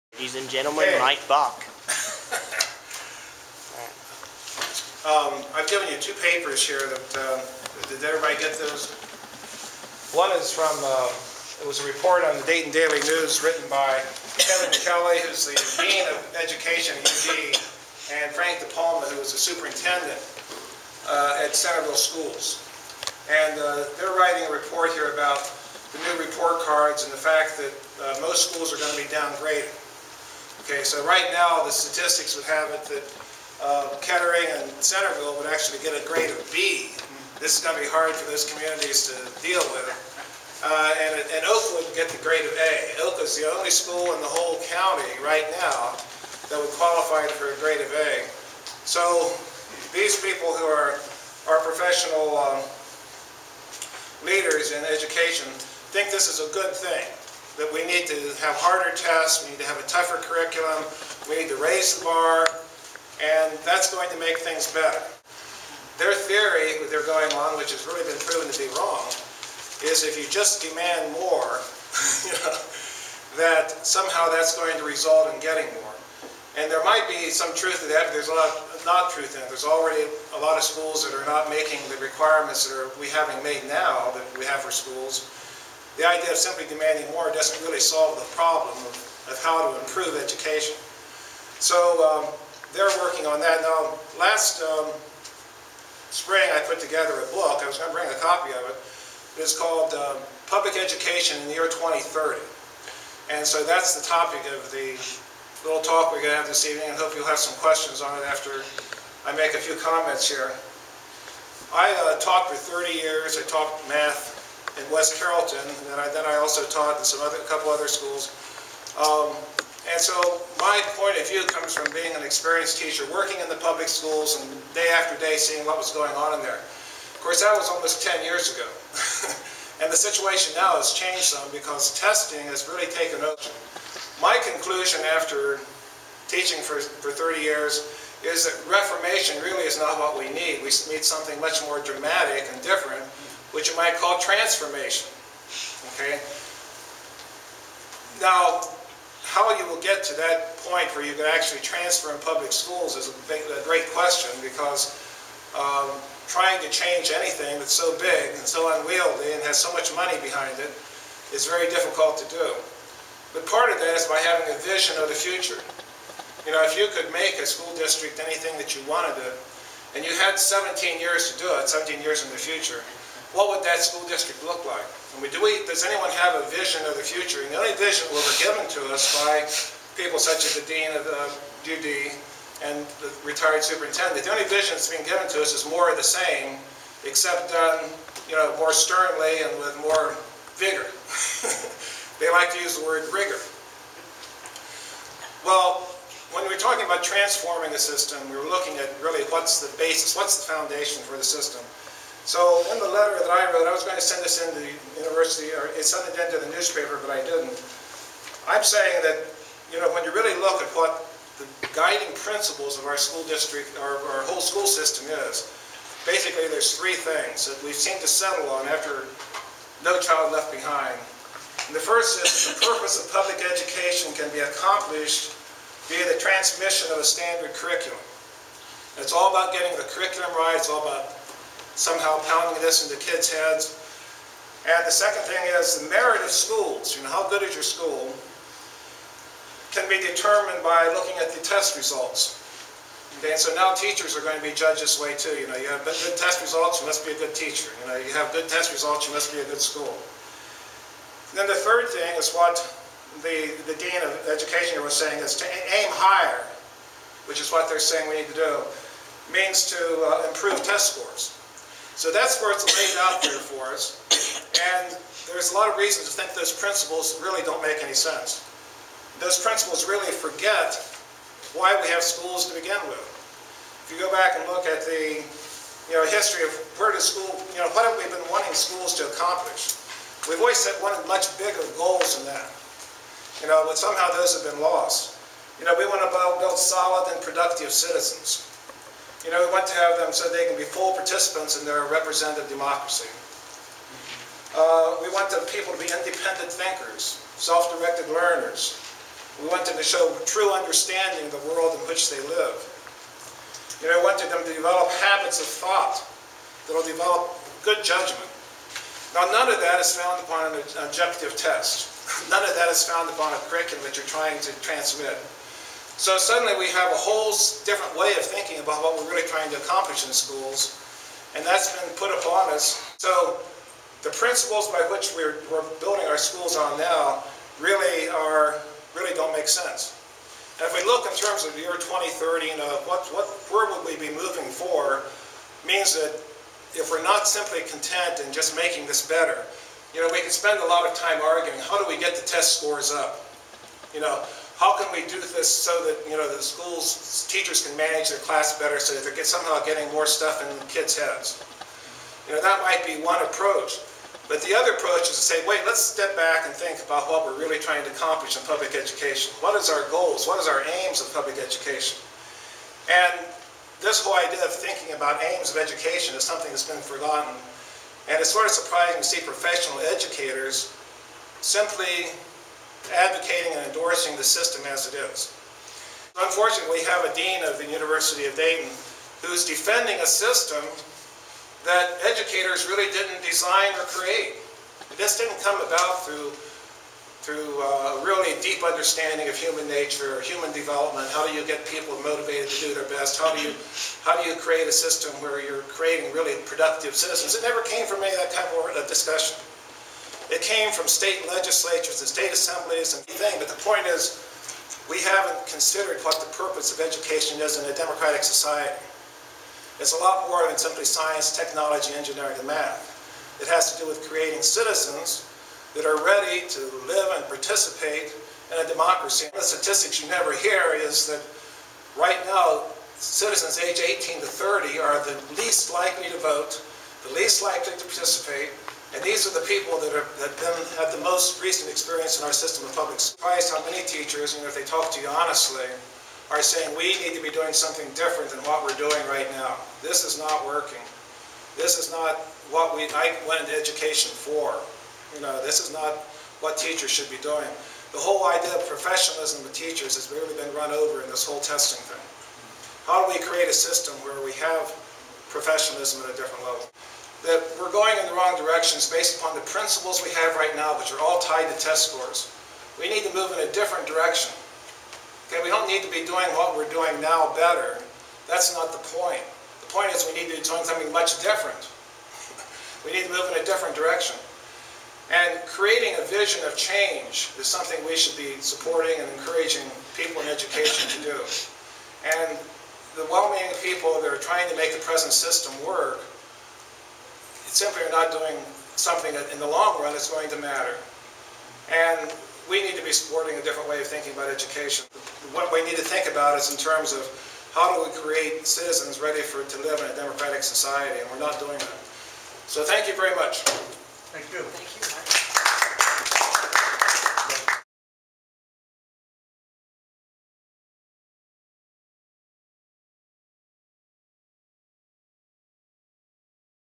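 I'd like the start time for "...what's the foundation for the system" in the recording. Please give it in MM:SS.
03:20.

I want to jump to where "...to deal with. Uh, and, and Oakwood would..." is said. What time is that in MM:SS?
00:39.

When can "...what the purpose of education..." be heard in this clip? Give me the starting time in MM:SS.
06:46.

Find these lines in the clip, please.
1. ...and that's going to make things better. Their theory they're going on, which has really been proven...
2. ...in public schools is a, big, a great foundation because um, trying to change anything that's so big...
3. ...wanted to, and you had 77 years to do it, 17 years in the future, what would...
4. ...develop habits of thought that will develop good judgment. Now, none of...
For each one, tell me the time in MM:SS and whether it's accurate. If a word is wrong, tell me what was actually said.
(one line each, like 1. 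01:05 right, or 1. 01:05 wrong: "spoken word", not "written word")
1. 01:03 right
2. 02:32 wrong: "question", not "foundation"
3. 02:48 wrong: "17", not "77"
4. 05:04 right.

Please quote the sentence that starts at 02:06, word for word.
Of course, that was almost 10 years ago.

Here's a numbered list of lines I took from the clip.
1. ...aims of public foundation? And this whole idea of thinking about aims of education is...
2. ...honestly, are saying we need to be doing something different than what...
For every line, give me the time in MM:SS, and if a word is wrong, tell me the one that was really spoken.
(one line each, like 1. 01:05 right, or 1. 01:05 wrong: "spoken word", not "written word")
1. 06:00 wrong: "education", not "foundation"
2. 07:15 right.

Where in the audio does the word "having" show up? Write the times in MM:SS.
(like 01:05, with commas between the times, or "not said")
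01:23, 02:44.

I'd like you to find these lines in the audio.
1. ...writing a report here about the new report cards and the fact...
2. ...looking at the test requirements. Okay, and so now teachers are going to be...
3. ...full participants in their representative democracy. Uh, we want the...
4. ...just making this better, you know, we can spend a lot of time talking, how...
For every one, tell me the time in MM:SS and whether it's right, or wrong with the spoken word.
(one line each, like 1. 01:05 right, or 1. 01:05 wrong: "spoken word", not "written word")
1. 00:24 right
2. 04:00 wrong: "results", not "requirements"
3. 04:50 right
4. 05:38 wrong: "arguing", not "talking".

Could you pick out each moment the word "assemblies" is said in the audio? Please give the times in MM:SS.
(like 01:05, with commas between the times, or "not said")
06:42.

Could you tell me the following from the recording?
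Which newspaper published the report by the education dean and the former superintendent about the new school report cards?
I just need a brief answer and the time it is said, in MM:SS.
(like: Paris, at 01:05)
Dayton Daily News, at 00:12.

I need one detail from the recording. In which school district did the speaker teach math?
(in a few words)
West Carrollton.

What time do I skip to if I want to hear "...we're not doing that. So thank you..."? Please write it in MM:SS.
08:21.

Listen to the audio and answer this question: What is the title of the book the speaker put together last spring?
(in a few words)
Public Education in the Year 2030.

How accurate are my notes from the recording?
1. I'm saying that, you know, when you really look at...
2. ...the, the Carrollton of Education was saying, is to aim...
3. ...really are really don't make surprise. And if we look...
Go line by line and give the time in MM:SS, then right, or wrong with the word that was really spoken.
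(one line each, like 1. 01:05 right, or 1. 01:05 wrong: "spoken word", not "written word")
1. 03:28 right
2. 04:13 wrong: "Dean", not "Carrollton"
3. 05:27 wrong: "sense", not "surprise".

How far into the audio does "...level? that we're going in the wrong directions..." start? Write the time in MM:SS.
07:36.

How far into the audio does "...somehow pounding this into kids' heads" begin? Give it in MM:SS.
03:51.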